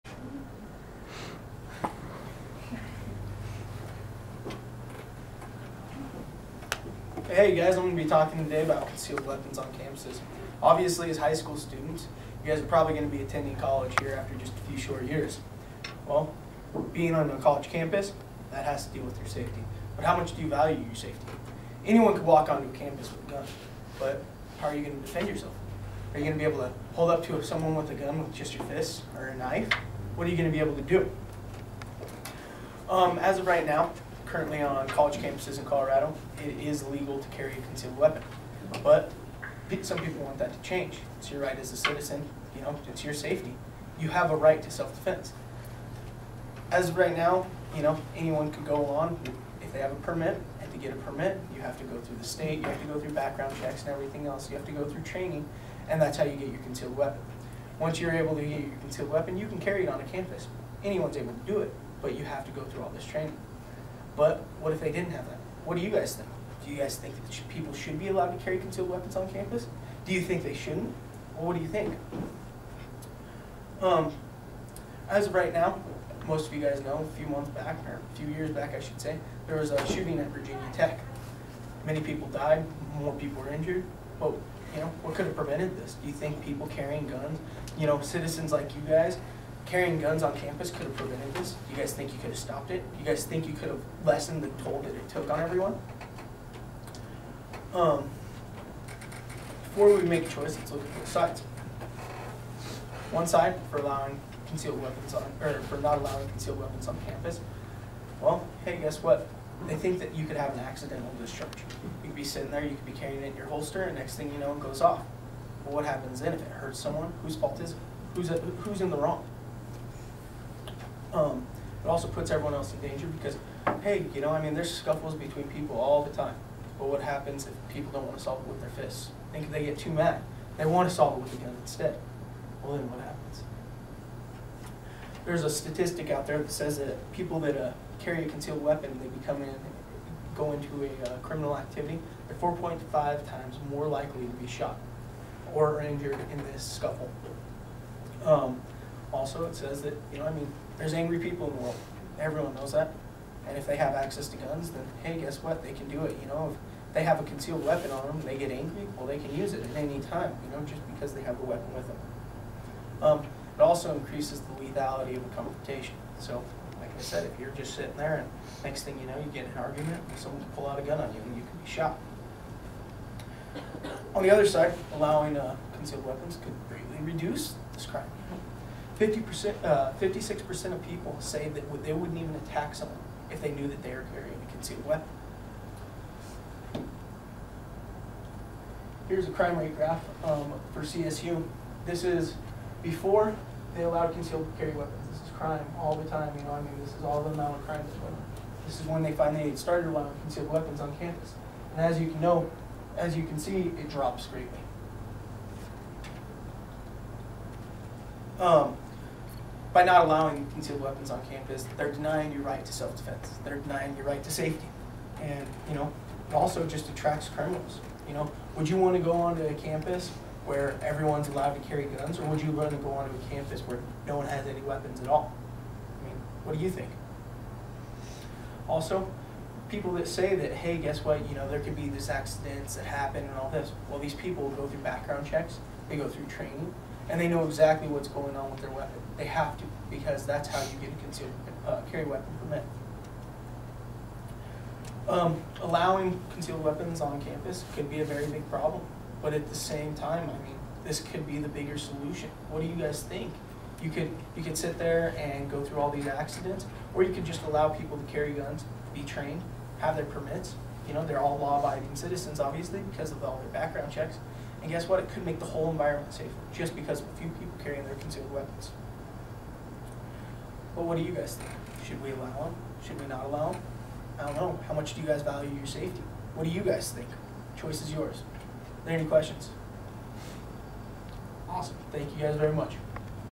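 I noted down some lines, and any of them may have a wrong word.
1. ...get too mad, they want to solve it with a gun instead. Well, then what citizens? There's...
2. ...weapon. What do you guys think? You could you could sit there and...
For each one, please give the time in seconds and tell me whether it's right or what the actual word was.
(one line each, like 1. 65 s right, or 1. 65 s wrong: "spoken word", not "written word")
1. 129 s wrong: "happens", not "citizens"
2. 251 s wrong: "solution", not "weapon".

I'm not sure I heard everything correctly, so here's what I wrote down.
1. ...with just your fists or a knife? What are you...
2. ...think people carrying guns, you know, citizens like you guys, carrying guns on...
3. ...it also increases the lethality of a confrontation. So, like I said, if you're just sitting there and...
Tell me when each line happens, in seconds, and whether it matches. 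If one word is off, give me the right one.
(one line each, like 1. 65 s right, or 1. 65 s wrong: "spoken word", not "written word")
1. 28 s right
2. 86 s right
3. 163 s right.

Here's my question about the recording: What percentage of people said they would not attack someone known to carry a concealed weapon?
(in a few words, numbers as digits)
56%.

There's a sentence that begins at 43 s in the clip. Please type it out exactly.
You have a right to self-defense.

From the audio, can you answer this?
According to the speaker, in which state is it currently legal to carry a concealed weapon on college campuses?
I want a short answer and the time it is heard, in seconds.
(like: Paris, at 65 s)
Colorado, at 35 s.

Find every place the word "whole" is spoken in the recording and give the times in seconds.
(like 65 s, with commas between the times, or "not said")
265 s.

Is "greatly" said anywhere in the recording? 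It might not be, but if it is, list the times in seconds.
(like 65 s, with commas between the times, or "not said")
176 s, 204 s.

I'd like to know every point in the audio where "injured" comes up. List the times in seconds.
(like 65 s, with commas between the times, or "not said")
83 s, 145 s.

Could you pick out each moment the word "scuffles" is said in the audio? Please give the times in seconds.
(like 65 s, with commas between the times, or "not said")
124 s, 146 s.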